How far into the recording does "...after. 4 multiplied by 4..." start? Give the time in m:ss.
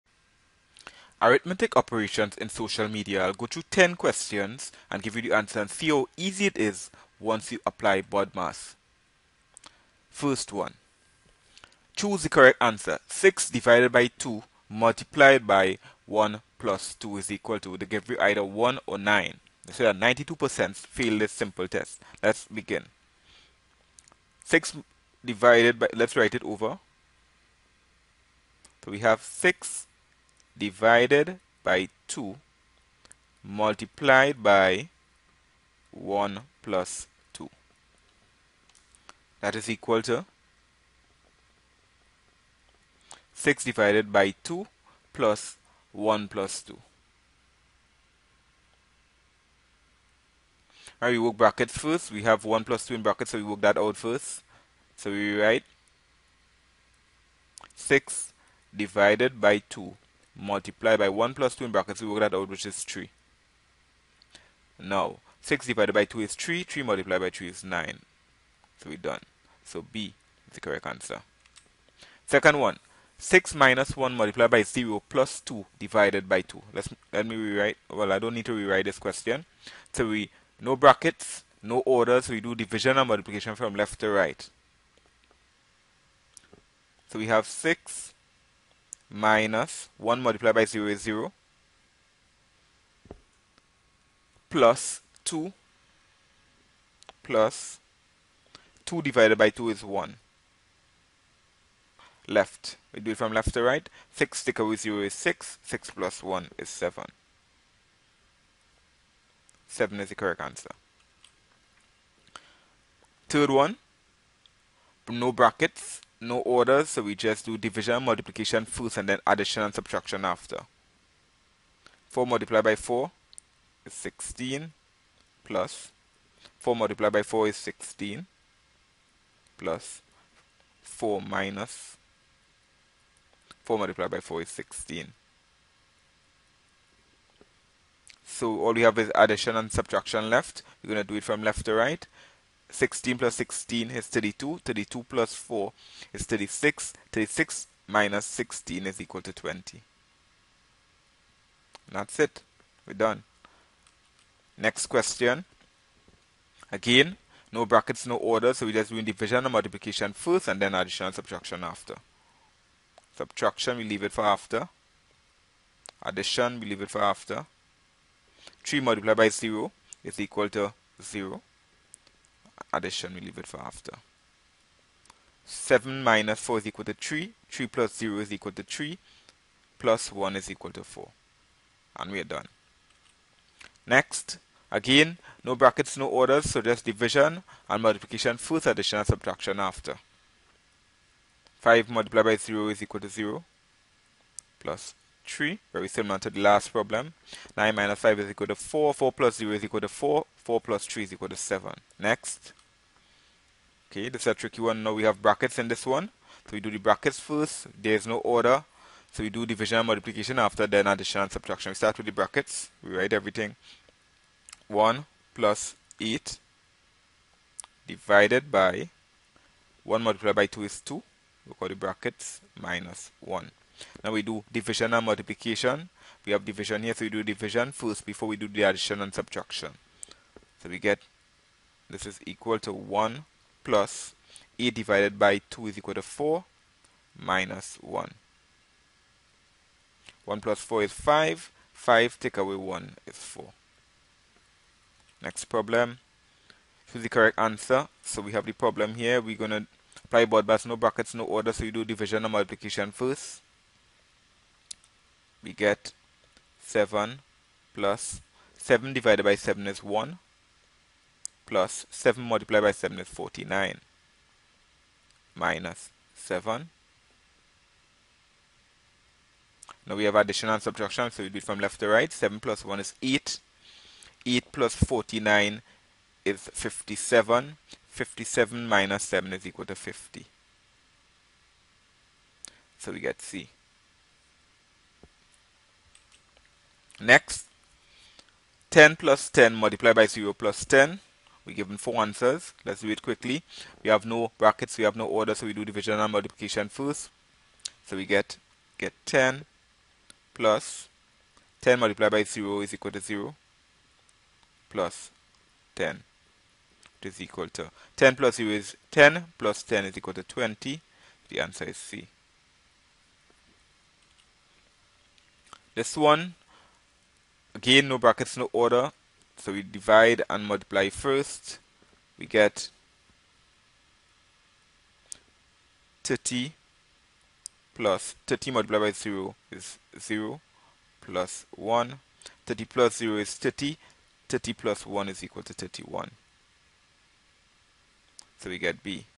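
2:00.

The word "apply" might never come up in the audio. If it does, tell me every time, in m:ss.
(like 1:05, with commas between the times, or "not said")
0:07, 4:10.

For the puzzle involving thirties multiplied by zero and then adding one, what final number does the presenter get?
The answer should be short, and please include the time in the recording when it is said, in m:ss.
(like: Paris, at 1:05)
31, at 5:35.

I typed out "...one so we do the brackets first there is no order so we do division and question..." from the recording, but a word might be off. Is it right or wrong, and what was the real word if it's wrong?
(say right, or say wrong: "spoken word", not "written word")
wrong: "multiplication", not "question".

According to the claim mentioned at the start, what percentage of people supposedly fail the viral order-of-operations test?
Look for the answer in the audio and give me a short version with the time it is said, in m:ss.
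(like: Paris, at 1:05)
92%, at 0:19.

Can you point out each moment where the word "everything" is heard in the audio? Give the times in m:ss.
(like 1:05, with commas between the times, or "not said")
3:33.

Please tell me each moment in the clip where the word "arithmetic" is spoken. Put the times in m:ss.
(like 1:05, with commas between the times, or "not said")
0:01.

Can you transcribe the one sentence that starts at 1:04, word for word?
Now, 6 divided by 2 is 3, 3 multiplied by 3 is 9.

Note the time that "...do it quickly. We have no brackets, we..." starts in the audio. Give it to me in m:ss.
4:52.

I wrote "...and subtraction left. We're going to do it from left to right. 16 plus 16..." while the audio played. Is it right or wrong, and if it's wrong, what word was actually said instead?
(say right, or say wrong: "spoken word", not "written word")
right.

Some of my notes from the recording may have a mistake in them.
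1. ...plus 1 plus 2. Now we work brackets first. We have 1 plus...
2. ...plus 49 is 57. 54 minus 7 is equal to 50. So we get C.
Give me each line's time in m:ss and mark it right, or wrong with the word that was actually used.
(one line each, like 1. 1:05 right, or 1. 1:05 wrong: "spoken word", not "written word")
1. 0:45 right
2. 4:34 wrong: "57", not "54".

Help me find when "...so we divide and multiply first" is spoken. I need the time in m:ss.
5:19.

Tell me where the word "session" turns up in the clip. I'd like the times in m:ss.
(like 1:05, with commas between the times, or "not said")
not said.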